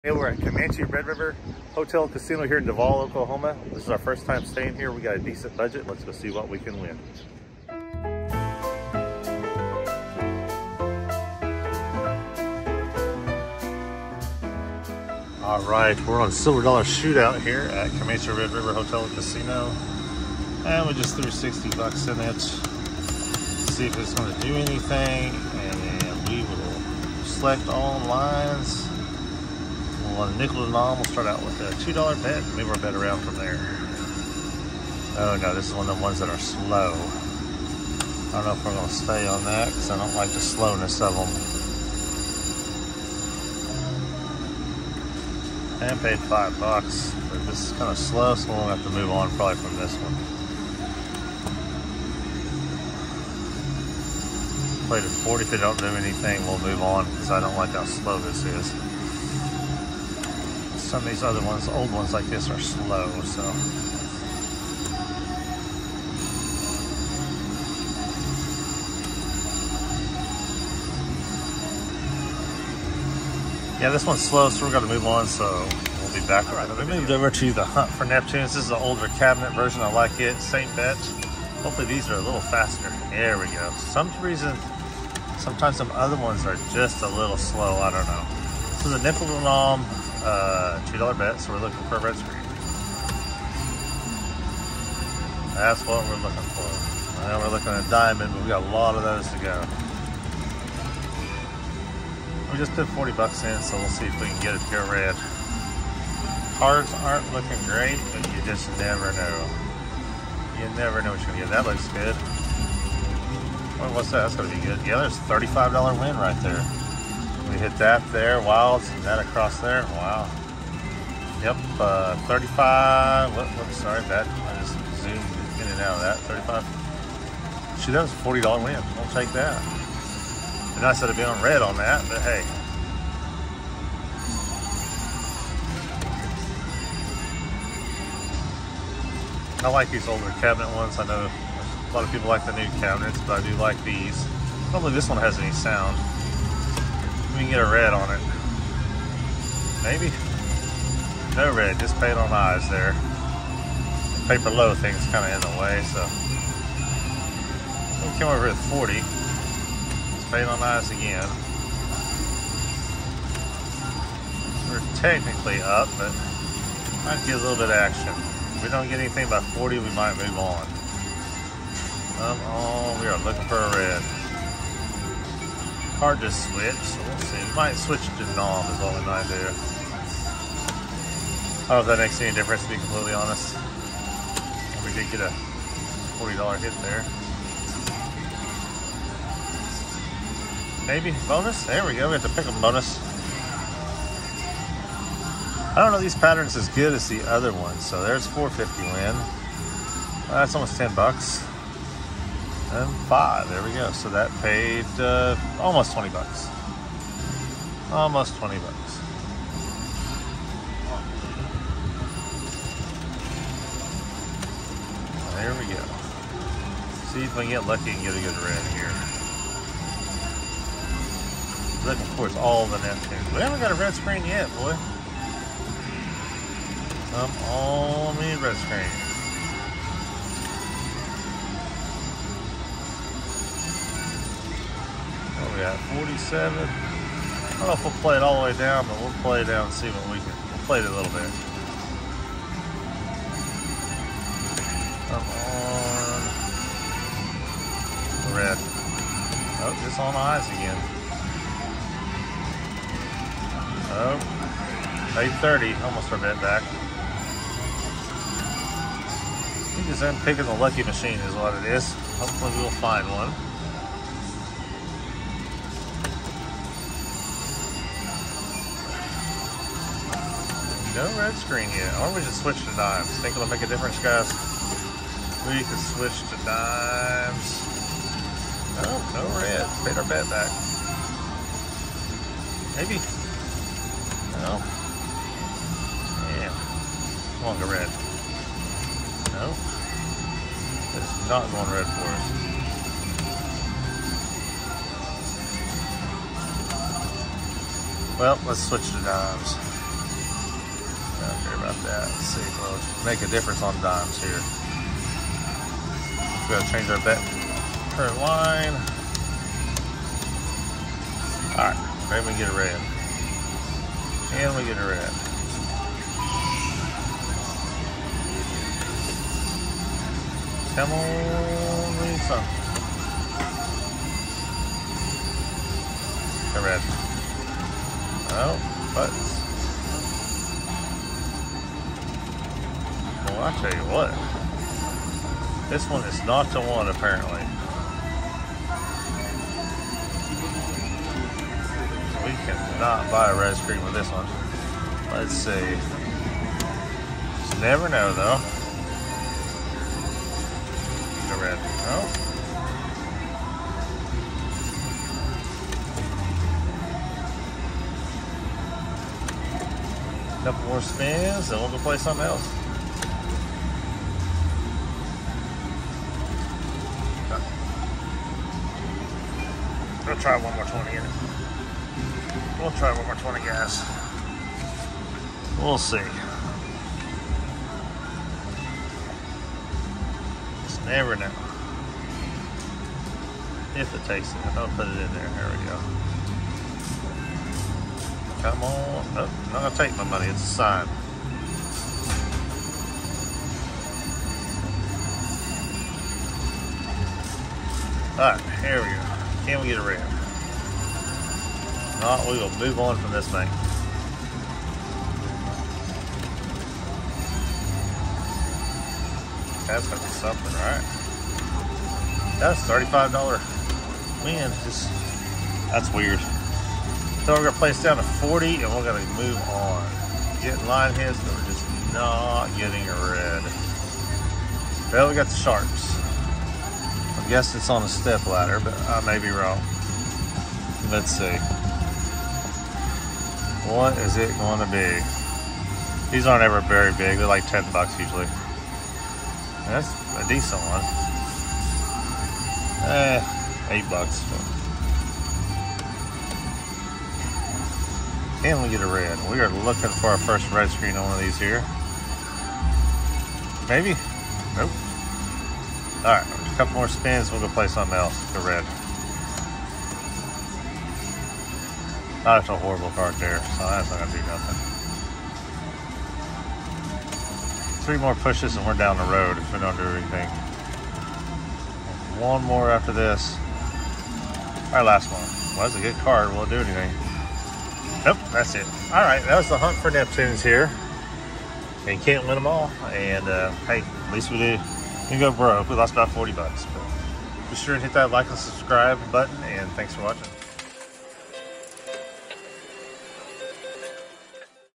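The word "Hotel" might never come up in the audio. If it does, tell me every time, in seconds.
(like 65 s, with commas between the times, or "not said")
1 s, 18 s.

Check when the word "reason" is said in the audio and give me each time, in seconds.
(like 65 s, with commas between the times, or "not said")
84 s.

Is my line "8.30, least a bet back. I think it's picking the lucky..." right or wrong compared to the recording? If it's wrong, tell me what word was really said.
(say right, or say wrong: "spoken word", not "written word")
wrong: "almost", not "least".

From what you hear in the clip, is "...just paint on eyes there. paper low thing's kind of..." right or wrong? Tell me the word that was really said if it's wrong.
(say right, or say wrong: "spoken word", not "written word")
right.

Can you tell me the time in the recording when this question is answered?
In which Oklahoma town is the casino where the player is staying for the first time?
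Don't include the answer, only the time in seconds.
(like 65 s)
2 s.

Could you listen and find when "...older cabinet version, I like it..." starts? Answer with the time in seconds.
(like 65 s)
78 s.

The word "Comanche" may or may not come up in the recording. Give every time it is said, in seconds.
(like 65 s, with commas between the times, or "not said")
0 s, 17 s.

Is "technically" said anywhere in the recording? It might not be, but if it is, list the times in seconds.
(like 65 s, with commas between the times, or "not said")
165 s.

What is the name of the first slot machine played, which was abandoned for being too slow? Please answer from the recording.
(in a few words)
Silver Dollar Shootout.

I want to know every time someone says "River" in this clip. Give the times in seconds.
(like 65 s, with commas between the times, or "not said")
1 s, 18 s.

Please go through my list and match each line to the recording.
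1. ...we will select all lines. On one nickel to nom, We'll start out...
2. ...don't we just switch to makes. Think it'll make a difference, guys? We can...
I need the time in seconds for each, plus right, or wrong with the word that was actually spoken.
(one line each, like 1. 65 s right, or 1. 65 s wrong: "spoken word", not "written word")
1. 26 s right
2. 272 s wrong: "dimes", not "makes".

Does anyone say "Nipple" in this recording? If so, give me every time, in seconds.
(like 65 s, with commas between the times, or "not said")
89 s.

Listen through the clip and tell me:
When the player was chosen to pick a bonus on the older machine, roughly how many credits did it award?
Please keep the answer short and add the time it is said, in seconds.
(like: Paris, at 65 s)
450, at 198 s.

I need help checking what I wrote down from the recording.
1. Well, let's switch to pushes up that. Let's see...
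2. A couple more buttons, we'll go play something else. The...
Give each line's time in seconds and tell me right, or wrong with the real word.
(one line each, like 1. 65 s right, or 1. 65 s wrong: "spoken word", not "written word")
1. 298 s wrong: "dimes", not "pushes"
2. 456 s wrong: "spins", not "buttons".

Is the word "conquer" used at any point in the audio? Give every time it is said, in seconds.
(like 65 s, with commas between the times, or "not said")
not said.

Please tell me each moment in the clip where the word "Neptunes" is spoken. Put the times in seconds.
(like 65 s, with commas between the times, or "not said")
78 s, 222 s, 479 s.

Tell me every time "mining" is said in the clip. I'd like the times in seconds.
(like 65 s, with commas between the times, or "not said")
not said.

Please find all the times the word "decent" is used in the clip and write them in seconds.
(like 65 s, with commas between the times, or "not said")
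5 s, 440 s.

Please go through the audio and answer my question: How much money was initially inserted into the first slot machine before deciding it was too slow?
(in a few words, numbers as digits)
$60.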